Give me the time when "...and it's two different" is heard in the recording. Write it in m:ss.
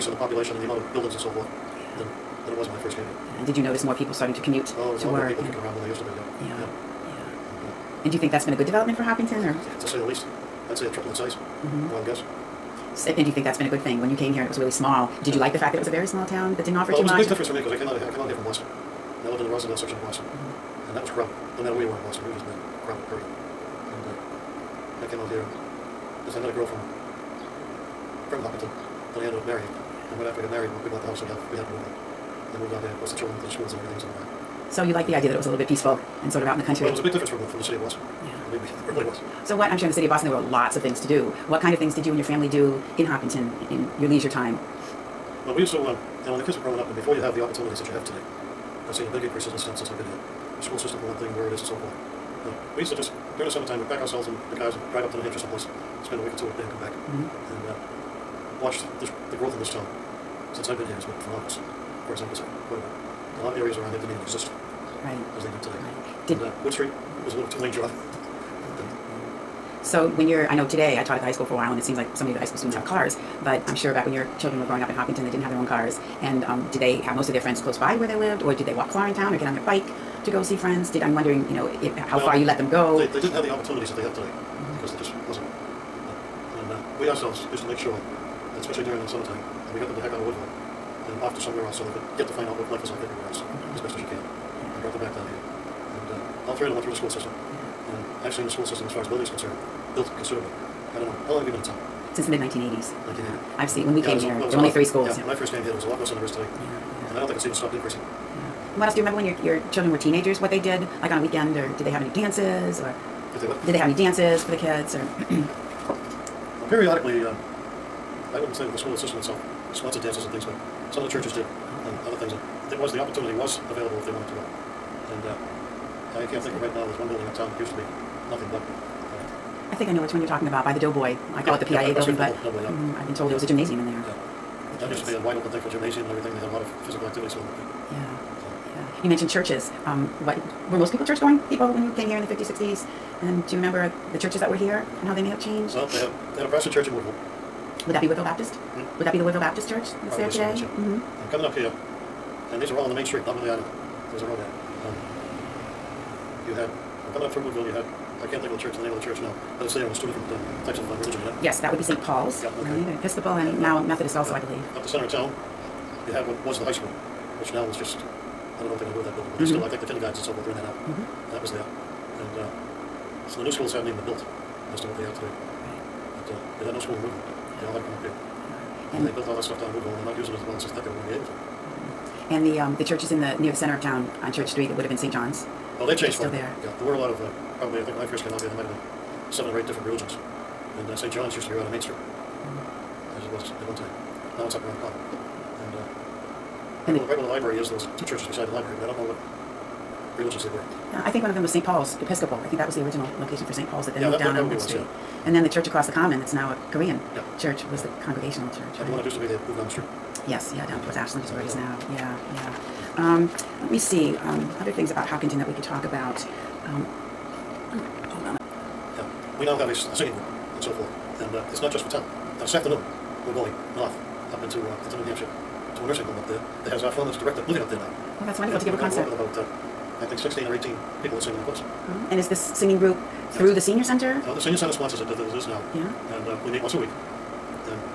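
2:39.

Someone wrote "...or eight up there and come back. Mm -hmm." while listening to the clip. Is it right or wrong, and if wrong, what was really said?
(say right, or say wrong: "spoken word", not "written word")
wrong: "two", not "eight".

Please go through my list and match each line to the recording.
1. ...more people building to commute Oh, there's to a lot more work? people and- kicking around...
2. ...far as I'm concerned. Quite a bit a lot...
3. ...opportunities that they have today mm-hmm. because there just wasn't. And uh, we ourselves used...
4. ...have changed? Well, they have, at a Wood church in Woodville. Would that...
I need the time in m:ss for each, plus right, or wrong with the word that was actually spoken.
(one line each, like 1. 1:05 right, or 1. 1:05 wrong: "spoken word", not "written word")
1. 0:03 wrong: "starting", not "building"
2. 1:02 right
3. 1:23 right
4. 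2:25 wrong: "Protestant", not "Wood".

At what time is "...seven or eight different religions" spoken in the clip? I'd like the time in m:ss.
3:09.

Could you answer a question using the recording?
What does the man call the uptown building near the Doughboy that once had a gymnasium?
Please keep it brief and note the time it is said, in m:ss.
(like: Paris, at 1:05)
PIA building, at 2:11.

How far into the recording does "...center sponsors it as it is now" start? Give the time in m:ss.
3:54.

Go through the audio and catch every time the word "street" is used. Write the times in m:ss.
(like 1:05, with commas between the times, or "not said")
1:06, 2:33, 3:04, 3:11, 3:24, 3:29.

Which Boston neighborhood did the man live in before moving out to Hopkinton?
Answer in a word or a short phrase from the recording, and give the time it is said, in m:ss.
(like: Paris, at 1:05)
Roslindale, at 0:19.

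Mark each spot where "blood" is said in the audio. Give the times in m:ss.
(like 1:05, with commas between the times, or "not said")
not said.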